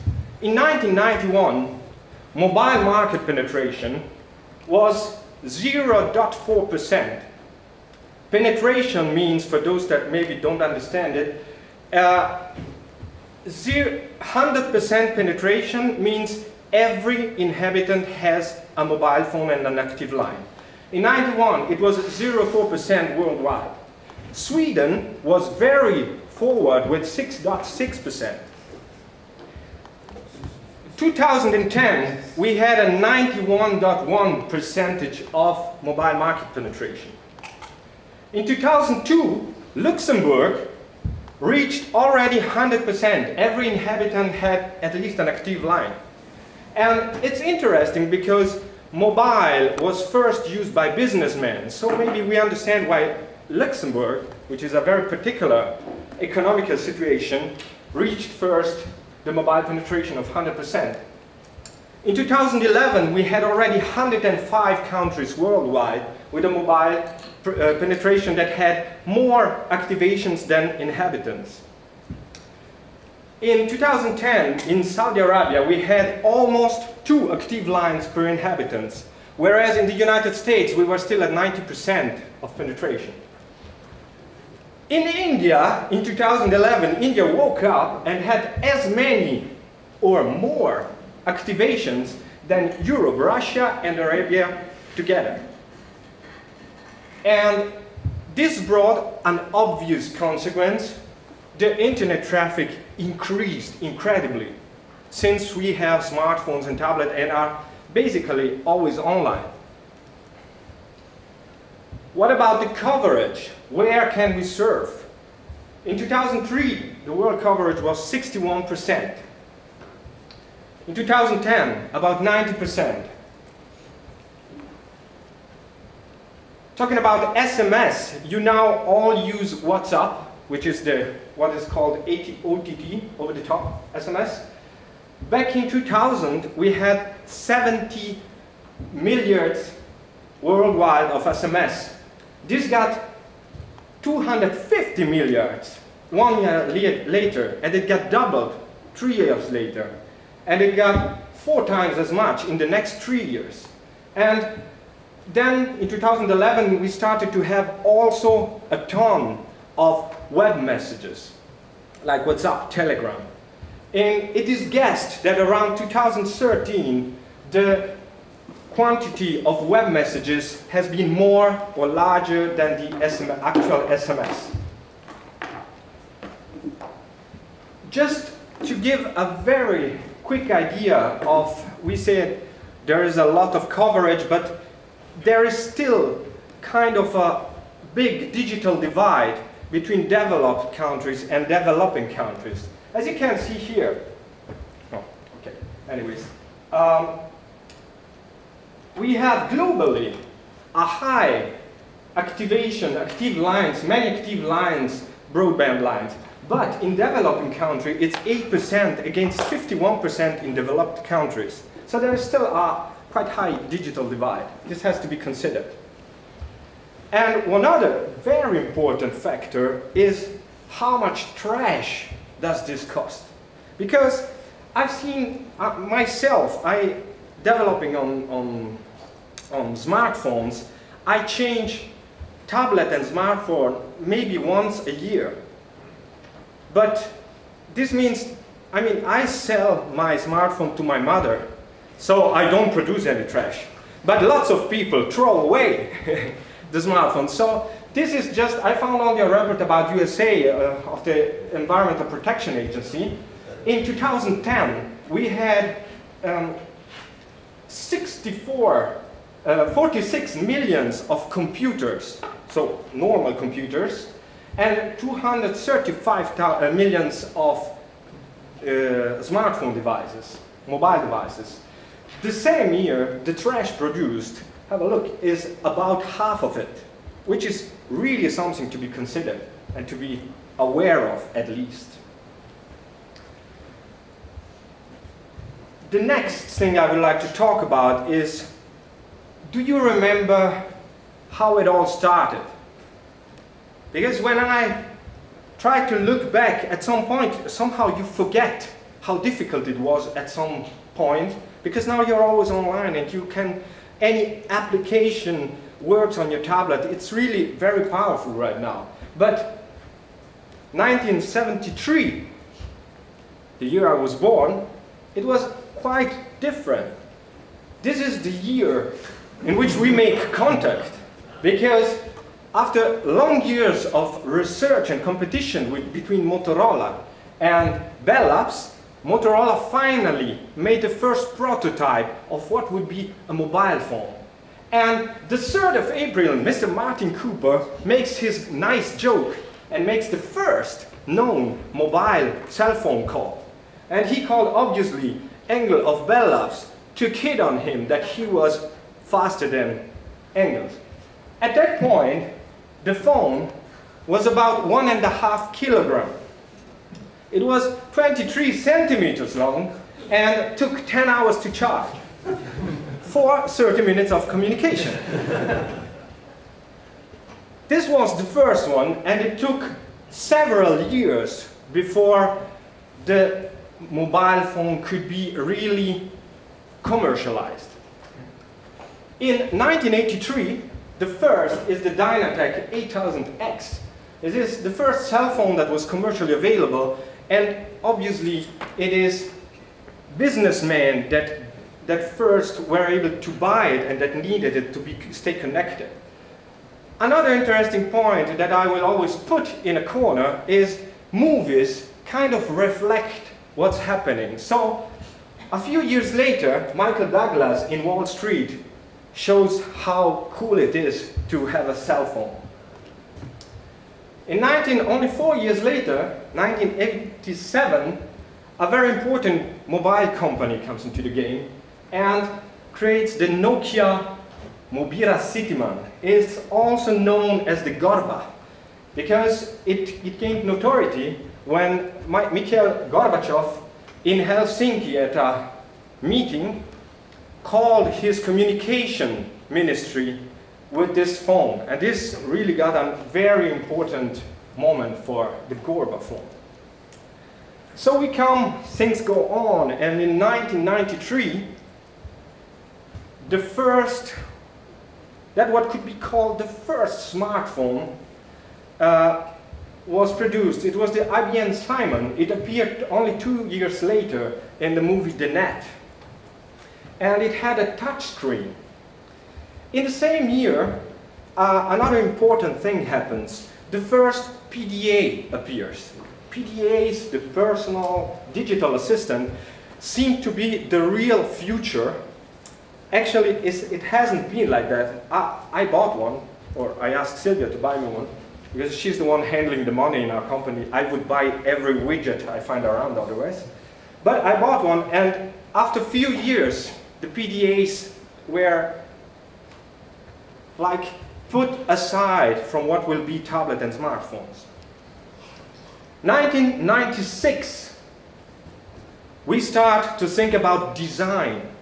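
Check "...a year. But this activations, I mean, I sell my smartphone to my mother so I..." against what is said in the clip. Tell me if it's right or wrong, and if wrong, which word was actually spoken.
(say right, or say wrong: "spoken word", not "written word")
wrong: "means", not "activations".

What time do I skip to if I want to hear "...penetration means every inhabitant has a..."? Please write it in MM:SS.
00:15.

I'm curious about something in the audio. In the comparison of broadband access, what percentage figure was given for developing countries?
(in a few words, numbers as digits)
8%.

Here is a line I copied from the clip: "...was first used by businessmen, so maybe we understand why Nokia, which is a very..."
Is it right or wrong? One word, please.
wrong.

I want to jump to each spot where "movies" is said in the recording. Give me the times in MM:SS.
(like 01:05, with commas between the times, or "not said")
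06:41, 07:44.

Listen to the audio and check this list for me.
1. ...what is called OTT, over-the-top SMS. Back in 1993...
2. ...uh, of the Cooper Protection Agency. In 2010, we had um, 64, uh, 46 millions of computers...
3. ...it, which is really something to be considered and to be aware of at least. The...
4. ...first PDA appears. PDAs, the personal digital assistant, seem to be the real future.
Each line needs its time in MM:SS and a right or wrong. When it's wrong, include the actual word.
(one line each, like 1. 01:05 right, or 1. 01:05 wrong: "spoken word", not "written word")
1. 02:11 wrong: "2000", not "1993"
2. 04:10 wrong: "Environmental", not "Cooper"
3. 04:36 right
4. 07:53 right.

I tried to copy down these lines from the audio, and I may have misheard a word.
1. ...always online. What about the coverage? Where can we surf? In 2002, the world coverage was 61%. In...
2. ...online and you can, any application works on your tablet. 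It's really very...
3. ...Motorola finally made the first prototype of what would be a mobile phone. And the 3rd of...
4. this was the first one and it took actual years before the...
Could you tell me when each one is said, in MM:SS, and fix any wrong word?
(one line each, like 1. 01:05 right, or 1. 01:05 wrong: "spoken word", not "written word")
1. 01:48 wrong: "2003", not "2002"
2. 05:02 right
3. 05:29 right
4. 06:07 wrong: "several", not "actual".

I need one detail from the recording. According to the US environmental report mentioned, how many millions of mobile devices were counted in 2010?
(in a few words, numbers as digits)
235 million.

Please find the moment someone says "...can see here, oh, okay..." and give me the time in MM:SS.
03:13.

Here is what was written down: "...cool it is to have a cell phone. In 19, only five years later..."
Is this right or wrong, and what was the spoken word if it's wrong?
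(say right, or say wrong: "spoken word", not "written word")
wrong: "four", not "five".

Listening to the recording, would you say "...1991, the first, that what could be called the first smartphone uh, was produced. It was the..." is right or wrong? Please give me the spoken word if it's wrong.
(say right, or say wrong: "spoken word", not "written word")
wrong: "1993", not "1991".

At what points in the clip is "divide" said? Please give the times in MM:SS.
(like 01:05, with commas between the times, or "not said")
03:08, 03:34.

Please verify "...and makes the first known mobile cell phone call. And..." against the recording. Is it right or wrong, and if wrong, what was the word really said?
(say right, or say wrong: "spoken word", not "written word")
right.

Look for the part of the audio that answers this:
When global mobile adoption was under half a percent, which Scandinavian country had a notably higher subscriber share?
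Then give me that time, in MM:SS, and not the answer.
00:24.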